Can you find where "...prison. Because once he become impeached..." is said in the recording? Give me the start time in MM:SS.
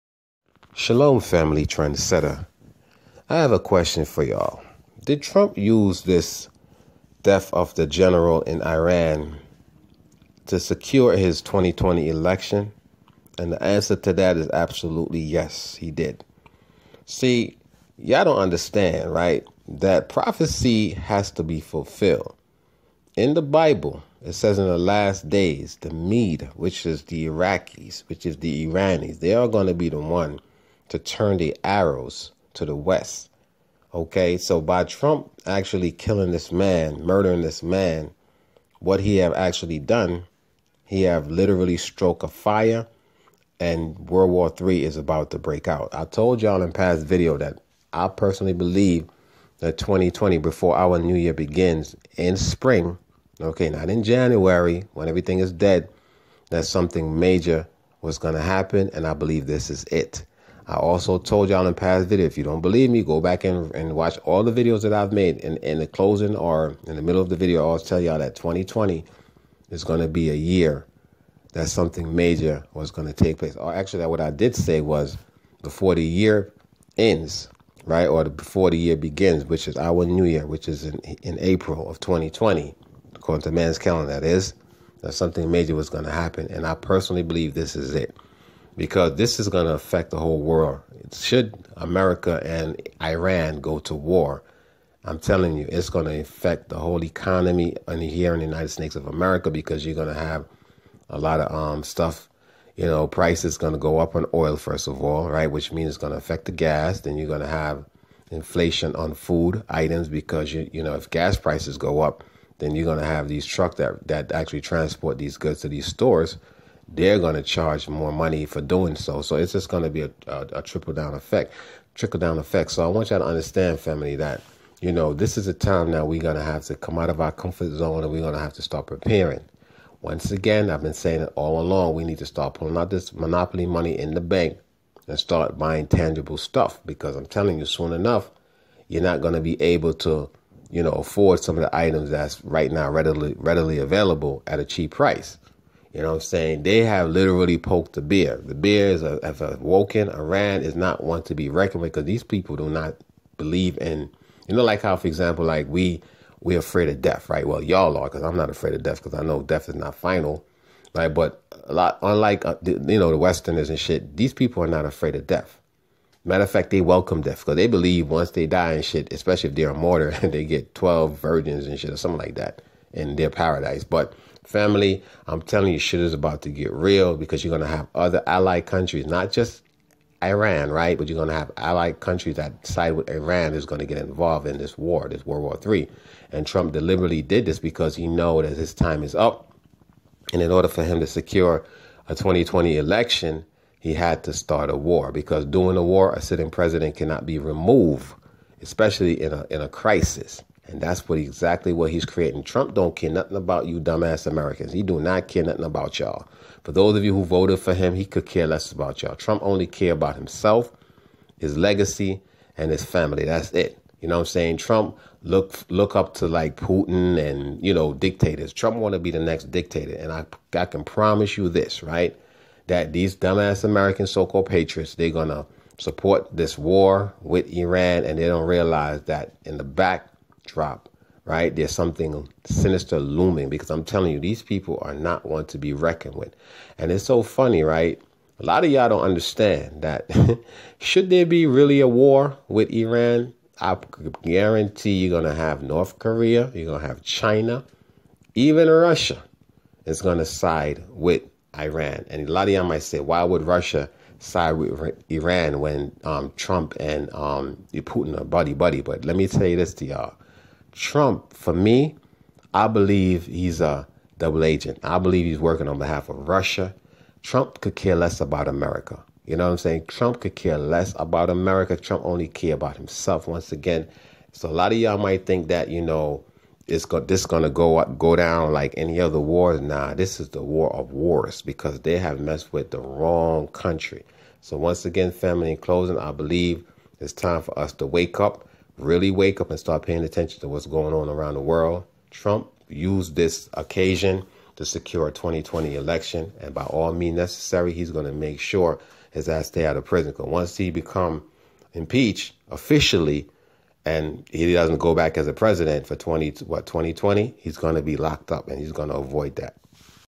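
04:59.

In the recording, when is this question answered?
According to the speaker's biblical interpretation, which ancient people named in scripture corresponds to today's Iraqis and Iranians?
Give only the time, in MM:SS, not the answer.
00:25.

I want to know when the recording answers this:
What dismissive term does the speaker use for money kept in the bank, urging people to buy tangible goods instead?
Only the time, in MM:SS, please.
02:13.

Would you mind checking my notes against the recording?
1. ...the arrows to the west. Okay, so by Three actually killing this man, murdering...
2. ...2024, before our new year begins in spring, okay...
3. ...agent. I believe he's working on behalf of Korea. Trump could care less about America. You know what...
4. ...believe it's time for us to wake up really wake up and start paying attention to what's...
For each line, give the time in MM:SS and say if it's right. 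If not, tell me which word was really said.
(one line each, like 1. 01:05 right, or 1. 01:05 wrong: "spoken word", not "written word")
1. 00:31 wrong: "Trump", not "Three"
2. 00:49 wrong: "2020", not "2024"
3. 04:24 wrong: "Russia", not "Korea"
4. 04:46 right.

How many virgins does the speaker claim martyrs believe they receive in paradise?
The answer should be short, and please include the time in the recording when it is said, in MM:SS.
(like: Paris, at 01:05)
12, at 02:50.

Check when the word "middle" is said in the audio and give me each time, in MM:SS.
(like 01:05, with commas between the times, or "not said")
01:07.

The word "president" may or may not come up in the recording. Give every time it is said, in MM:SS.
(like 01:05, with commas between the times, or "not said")
03:16, 05:05.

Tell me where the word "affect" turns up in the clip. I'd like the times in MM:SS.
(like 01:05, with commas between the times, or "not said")
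01:29, 01:36, 01:46.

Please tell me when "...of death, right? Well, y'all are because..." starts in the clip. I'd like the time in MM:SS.
02:36.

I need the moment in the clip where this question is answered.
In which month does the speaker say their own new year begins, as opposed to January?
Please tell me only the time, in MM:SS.
01:21.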